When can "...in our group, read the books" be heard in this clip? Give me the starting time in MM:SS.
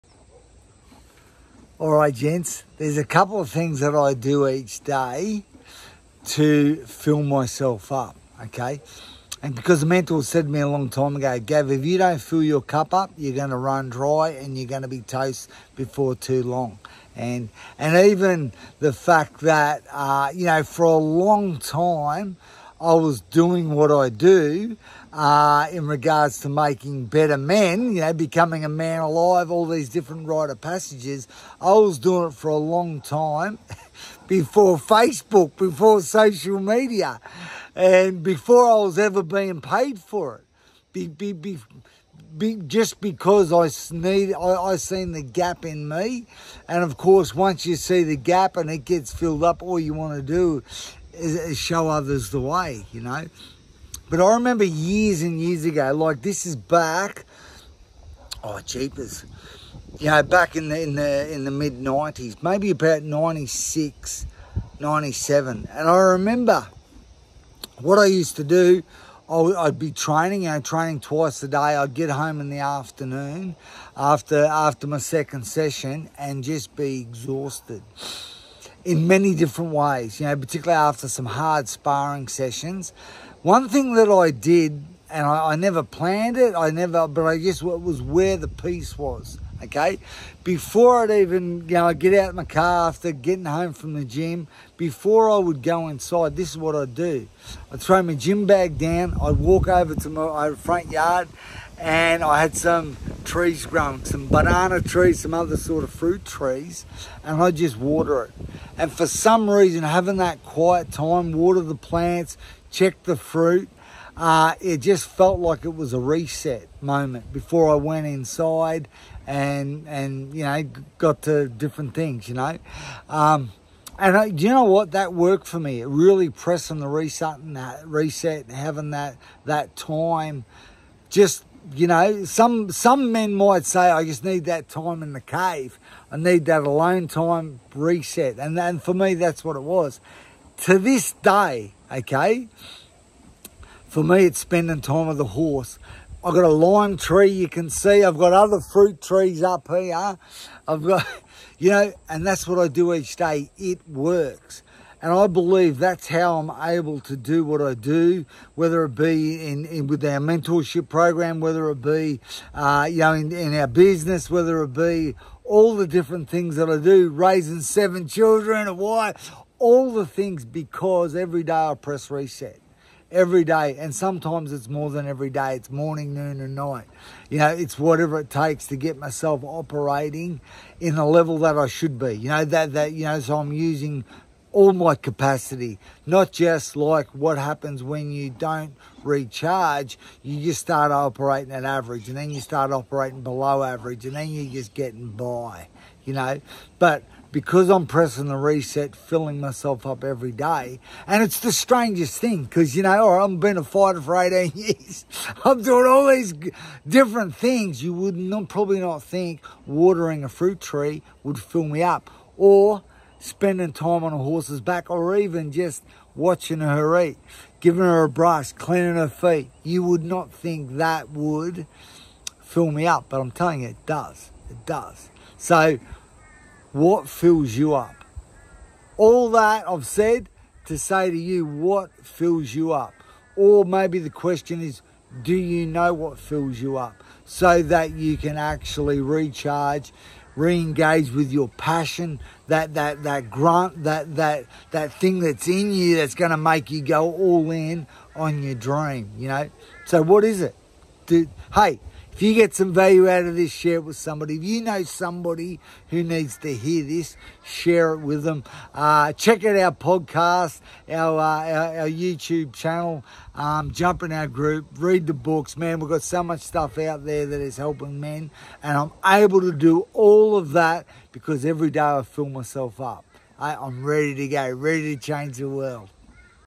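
04:24.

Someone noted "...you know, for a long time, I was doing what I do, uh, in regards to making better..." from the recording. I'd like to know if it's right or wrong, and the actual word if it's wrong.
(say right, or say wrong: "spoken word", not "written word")
right.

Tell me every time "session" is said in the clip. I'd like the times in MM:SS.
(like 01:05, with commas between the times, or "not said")
01:15, 01:22.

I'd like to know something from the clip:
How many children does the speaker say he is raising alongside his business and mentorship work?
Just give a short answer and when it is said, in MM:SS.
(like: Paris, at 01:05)
7, at 02:47.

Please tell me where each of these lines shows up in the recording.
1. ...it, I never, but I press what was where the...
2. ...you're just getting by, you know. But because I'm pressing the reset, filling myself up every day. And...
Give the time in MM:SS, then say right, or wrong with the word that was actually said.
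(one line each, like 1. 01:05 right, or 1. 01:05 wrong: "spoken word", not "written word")
1. 01:26 wrong: "guess", not "press"
2. 03:14 right.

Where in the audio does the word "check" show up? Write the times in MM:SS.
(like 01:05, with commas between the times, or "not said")
01:52, 04:19.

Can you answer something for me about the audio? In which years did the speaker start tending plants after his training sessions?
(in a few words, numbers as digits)
'96, '97.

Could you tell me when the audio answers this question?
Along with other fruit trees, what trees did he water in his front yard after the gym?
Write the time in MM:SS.
01:44.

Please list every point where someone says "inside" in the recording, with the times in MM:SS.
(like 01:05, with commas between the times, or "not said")
01:35, 01:58.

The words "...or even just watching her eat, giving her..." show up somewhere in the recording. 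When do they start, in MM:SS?
03:34.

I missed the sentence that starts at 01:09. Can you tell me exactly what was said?
I'd be training, you know, training twice a day.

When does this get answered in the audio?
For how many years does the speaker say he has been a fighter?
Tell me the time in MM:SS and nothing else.
03:24.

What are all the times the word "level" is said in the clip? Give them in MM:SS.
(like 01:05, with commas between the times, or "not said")
03:01.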